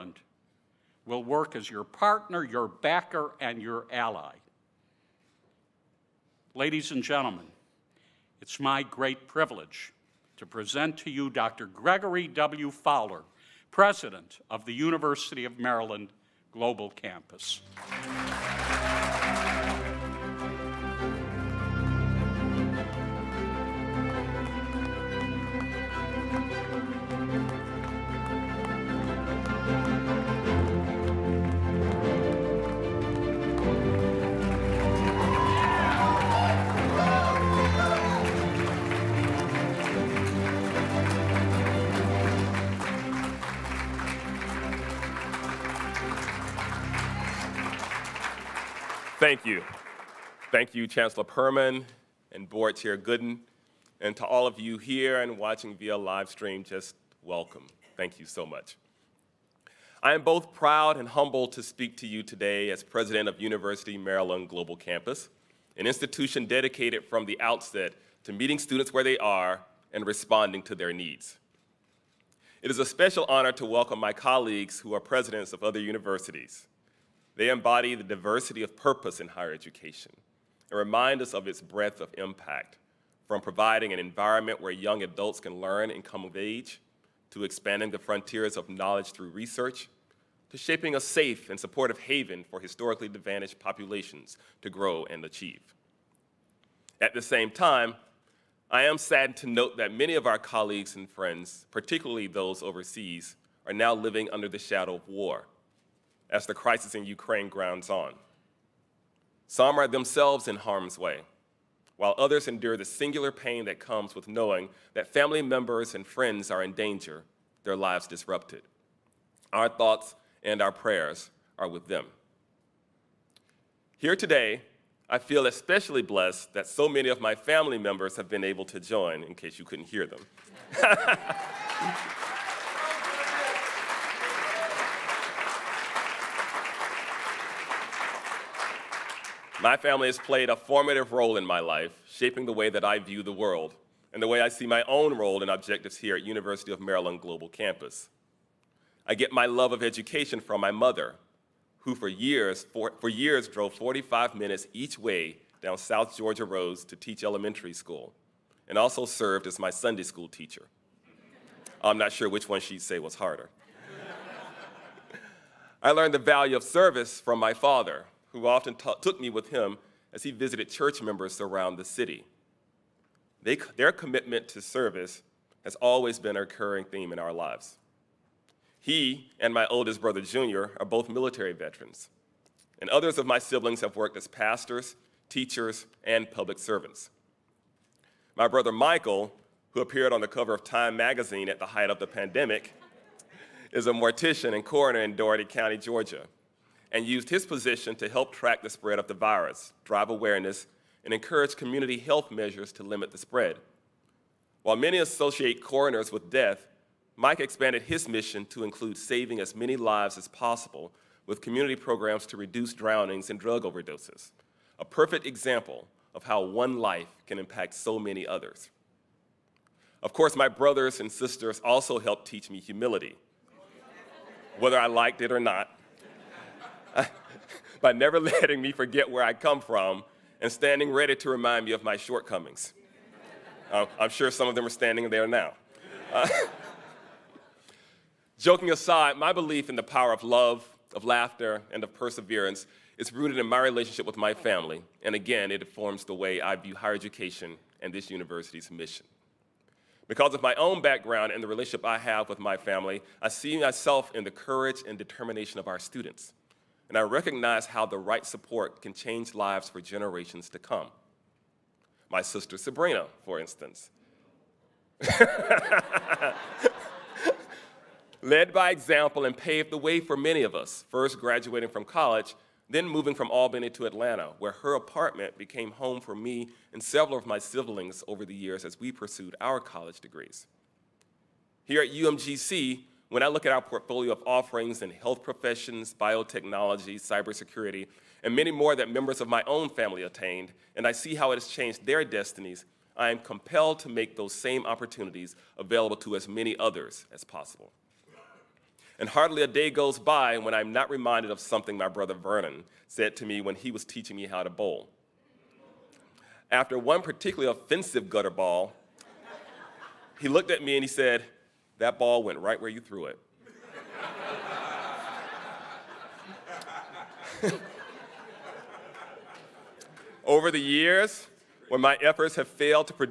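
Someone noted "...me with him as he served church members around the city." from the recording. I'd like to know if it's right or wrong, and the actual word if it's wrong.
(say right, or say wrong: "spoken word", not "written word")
wrong: "visited", not "served".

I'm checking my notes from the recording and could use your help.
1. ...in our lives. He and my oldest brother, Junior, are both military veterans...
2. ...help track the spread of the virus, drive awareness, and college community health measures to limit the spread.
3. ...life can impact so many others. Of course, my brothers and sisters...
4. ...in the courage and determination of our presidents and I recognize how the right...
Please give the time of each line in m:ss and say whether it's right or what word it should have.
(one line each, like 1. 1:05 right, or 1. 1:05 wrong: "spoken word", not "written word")
1. 2:57 right
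2. 3:18 wrong: "encourage", not "college"
3. 3:36 right
4. 4:14 wrong: "students", not "presidents".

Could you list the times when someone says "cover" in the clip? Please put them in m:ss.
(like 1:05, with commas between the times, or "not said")
3:10.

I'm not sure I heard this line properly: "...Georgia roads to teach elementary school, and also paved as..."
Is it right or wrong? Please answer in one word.
wrong.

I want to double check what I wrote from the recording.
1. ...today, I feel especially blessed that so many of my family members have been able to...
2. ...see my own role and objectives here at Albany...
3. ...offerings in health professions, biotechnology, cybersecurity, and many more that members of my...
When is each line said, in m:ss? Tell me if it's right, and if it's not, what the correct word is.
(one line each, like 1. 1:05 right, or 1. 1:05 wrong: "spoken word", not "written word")
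1. 2:04 right
2. 2:24 wrong: "University", not "Albany"
3. 4:44 right.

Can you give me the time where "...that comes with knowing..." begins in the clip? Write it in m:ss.
1:53.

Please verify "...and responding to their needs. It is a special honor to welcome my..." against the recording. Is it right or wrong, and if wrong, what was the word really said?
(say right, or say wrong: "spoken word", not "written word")
right.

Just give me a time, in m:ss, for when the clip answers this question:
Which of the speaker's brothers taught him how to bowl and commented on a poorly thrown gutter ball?
5:02.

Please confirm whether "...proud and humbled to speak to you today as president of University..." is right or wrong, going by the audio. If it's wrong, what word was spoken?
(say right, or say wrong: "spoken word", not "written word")
right.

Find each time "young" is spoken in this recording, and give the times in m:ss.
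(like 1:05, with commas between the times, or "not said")
1:24.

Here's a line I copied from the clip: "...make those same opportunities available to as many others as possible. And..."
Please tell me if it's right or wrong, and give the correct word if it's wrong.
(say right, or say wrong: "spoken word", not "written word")
right.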